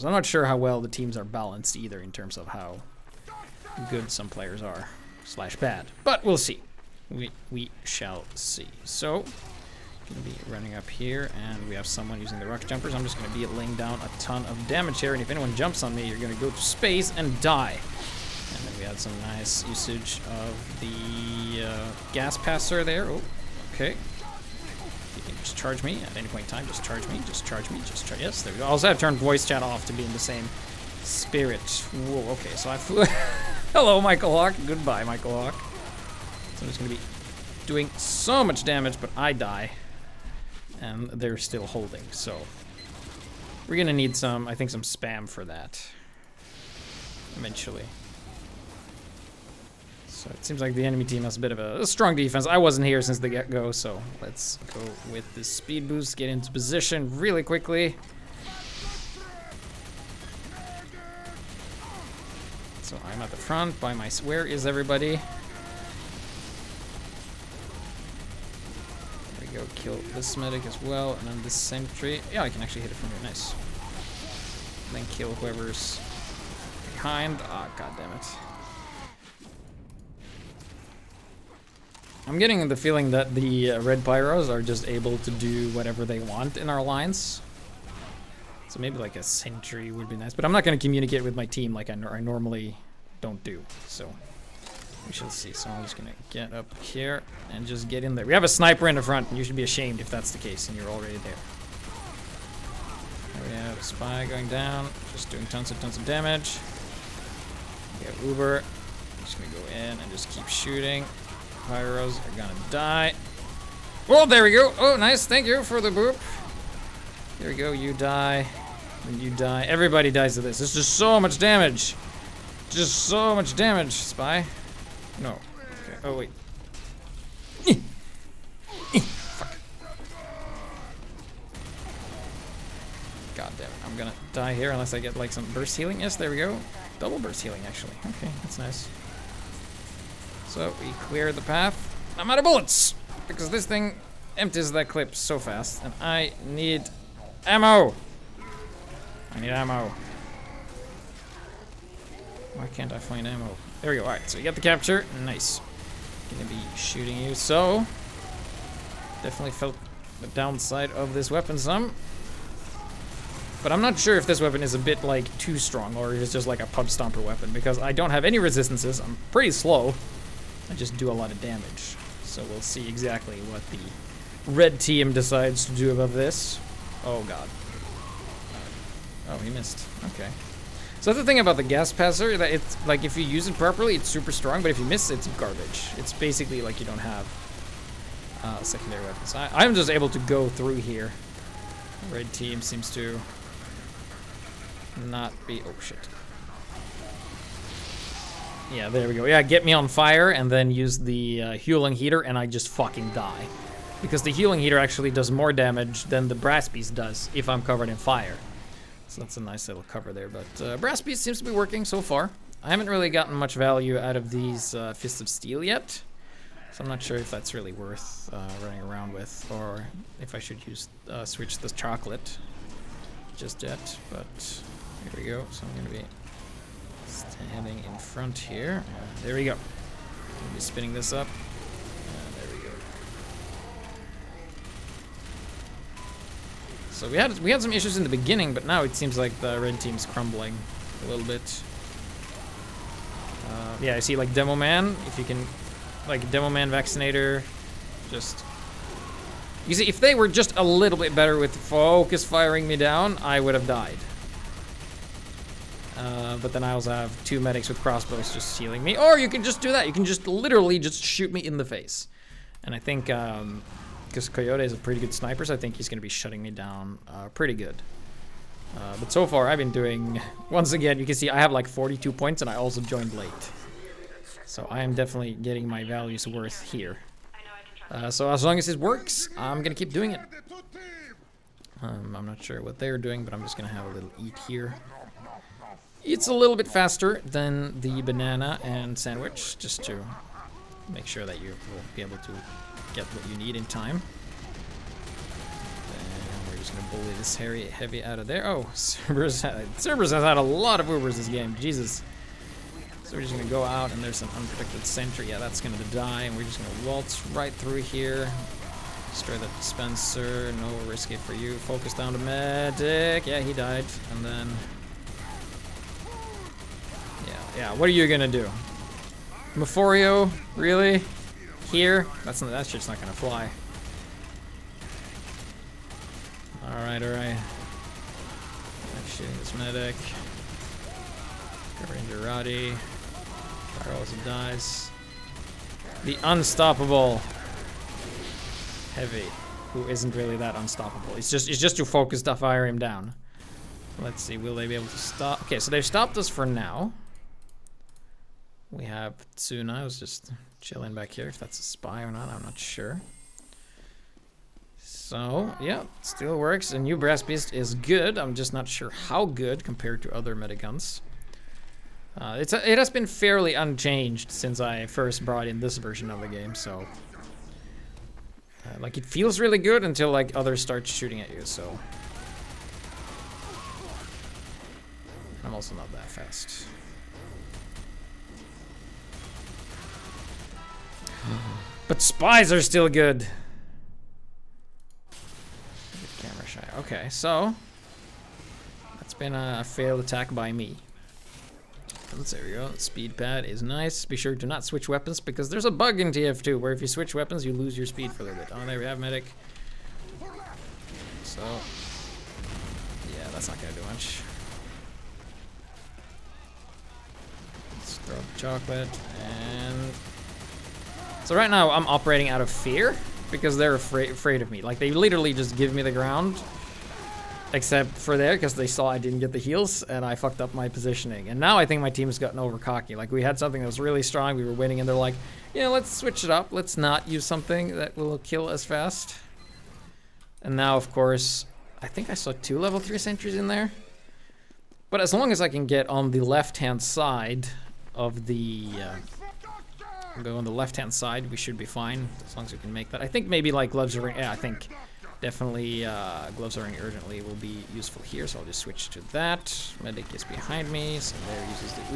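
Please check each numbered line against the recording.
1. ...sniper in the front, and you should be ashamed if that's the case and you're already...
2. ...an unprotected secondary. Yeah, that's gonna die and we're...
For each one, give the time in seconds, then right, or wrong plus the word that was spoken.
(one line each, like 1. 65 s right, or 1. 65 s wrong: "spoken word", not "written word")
1. 98 s right
2. 304 s wrong: "sentry", not "secondary".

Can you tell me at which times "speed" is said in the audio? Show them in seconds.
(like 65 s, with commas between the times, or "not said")
55 s, 392 s, 397 s.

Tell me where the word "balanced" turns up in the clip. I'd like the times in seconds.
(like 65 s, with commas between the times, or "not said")
1 s.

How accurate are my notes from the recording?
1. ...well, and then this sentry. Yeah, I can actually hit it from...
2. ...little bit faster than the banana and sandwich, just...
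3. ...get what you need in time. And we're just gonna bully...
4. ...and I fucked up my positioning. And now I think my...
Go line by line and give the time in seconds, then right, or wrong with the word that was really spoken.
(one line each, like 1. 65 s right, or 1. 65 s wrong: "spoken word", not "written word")
1. 70 s right
2. 286 s right
3. 292 s right
4. 419 s right.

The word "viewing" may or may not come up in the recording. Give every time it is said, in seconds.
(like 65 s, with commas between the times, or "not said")
not said.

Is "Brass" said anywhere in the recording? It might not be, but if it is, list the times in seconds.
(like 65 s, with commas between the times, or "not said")
206 s, 210 s, 356 s.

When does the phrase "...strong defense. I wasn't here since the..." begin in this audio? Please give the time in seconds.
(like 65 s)
51 s.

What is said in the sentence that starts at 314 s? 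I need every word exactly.
And then yeah, what are you gonna do?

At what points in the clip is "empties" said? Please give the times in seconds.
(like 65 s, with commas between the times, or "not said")
144 s.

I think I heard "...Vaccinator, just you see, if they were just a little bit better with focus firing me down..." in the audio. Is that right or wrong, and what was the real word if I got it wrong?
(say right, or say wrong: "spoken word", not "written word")
right.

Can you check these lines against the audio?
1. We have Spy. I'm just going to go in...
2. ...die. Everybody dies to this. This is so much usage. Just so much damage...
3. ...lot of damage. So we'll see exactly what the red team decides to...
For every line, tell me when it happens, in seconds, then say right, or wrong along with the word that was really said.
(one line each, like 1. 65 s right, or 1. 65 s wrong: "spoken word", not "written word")
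1. 107 s wrong: "Uber", not "Spy"
2. 119 s wrong: "damage", not "usage"
3. 171 s right.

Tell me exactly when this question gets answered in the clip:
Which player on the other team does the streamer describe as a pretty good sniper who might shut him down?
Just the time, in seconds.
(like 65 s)
264 s.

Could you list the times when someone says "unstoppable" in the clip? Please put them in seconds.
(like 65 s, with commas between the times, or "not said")
336 s, 340 s.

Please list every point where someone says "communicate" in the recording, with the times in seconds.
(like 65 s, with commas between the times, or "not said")
90 s.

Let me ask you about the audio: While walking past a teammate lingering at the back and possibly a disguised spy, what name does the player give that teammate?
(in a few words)
Tsuna.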